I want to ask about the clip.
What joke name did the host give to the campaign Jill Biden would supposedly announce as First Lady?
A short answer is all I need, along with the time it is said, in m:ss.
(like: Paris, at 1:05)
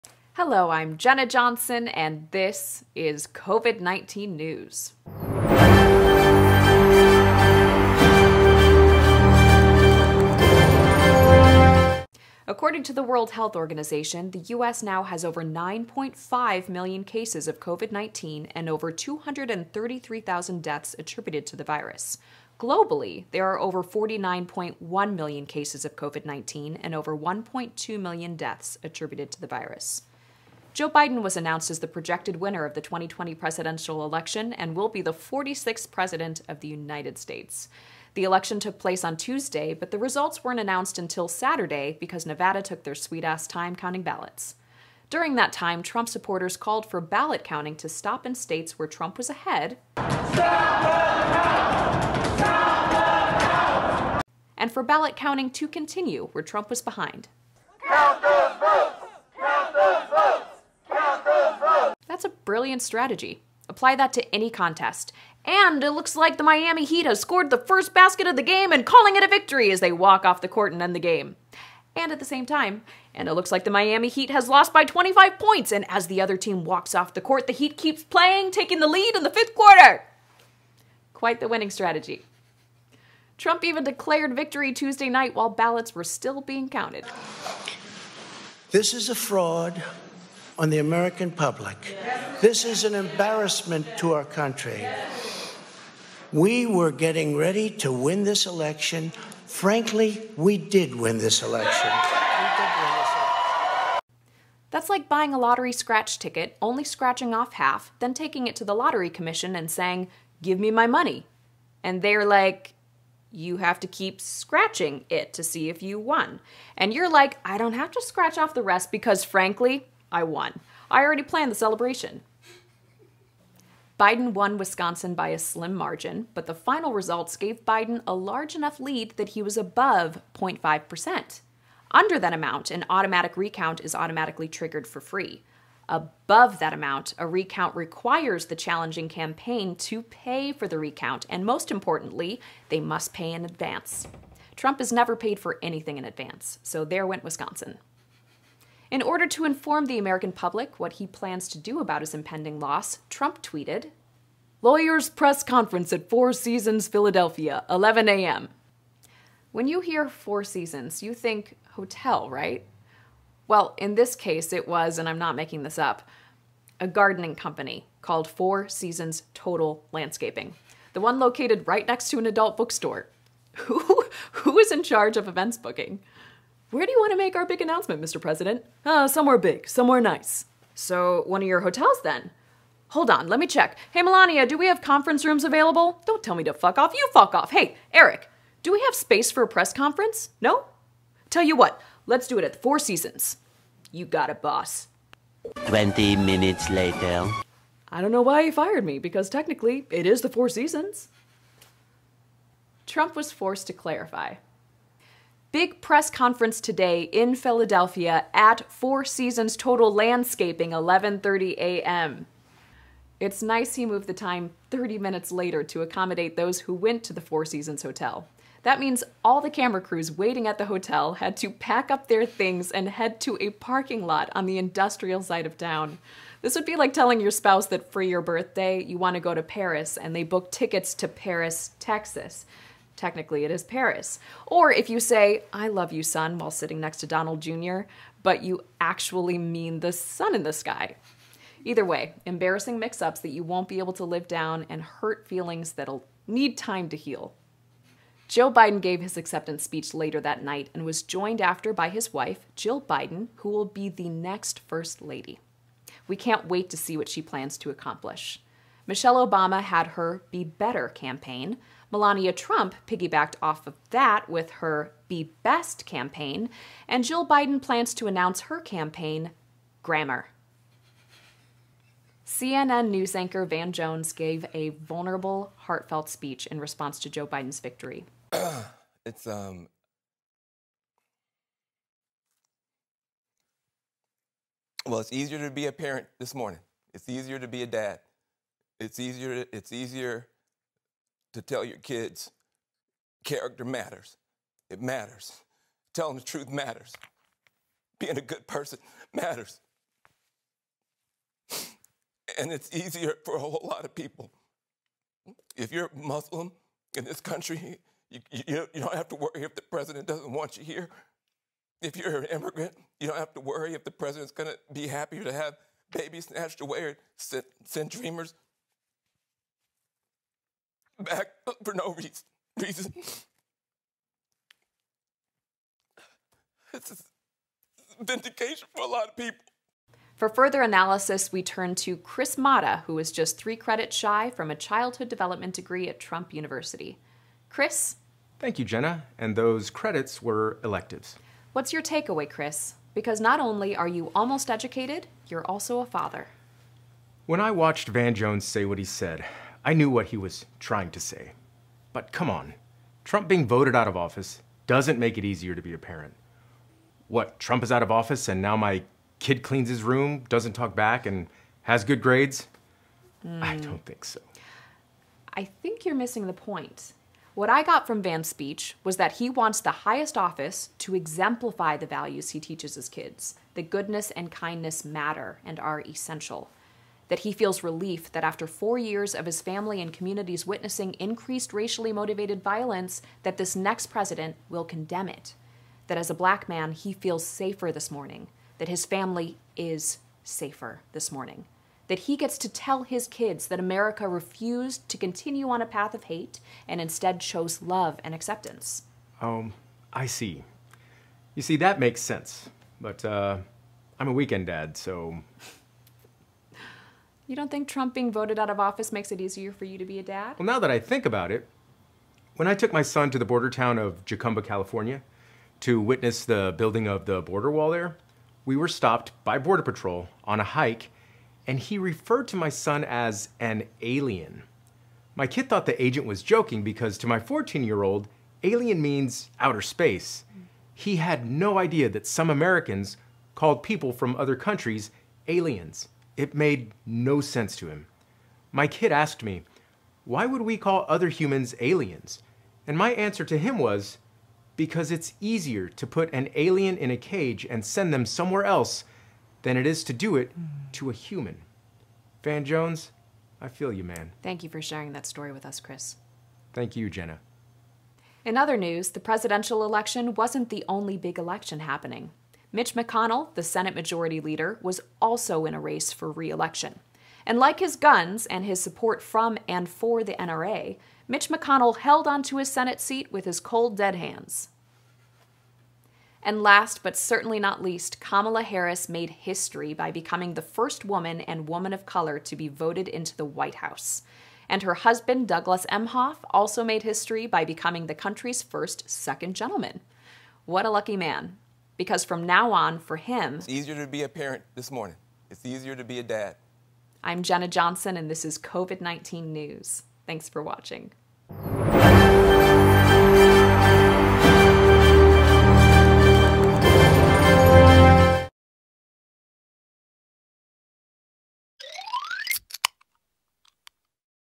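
Grammar, at 4:29.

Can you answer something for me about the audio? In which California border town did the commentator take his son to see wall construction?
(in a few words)
Jacumba.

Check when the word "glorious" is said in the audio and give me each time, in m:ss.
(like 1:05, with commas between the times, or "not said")
not said.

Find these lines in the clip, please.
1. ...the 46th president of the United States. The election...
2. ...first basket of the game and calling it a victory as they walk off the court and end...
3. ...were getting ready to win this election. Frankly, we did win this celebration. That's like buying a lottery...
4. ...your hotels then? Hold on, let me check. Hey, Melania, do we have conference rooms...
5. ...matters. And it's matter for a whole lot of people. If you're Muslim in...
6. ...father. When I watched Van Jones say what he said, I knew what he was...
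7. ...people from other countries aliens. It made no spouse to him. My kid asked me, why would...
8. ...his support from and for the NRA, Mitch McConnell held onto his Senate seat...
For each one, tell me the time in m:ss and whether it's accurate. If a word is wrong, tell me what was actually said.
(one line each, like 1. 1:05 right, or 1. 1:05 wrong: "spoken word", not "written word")
1. 0:35 right
2. 1:07 right
3. 1:36 wrong: "election", not "celebration"
4. 3:01 right
5. 4:59 wrong: "easier", not "matter"
6. 5:45 right
7. 7:13 wrong: "sense", not "spouse"
8. 7:48 right.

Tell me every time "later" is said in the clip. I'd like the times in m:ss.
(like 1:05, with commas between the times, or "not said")
3:16, 3:35, 4:09.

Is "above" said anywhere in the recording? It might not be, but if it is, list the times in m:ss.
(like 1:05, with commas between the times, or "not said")
2:09, 2:15.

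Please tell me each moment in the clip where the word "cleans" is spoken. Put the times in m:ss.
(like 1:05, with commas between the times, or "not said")
5:59.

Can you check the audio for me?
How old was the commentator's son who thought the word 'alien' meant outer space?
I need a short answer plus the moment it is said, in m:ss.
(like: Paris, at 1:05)
14, at 7:07.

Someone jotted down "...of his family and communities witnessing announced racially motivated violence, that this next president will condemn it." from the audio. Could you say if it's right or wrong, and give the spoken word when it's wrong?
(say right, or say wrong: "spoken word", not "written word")
wrong: "increased", not "announced".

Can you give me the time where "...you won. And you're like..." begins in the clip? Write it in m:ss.
1:55.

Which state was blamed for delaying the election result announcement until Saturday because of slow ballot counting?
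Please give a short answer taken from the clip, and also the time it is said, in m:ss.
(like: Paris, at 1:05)
Nevada, at 0:42.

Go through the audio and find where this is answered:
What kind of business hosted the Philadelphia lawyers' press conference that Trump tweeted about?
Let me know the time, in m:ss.
2:46.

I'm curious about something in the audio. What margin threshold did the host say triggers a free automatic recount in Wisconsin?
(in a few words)
0.5%.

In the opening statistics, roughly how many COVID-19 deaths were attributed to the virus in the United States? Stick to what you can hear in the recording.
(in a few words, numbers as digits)
over 233,000.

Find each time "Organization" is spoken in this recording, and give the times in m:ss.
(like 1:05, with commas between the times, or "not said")
0:13.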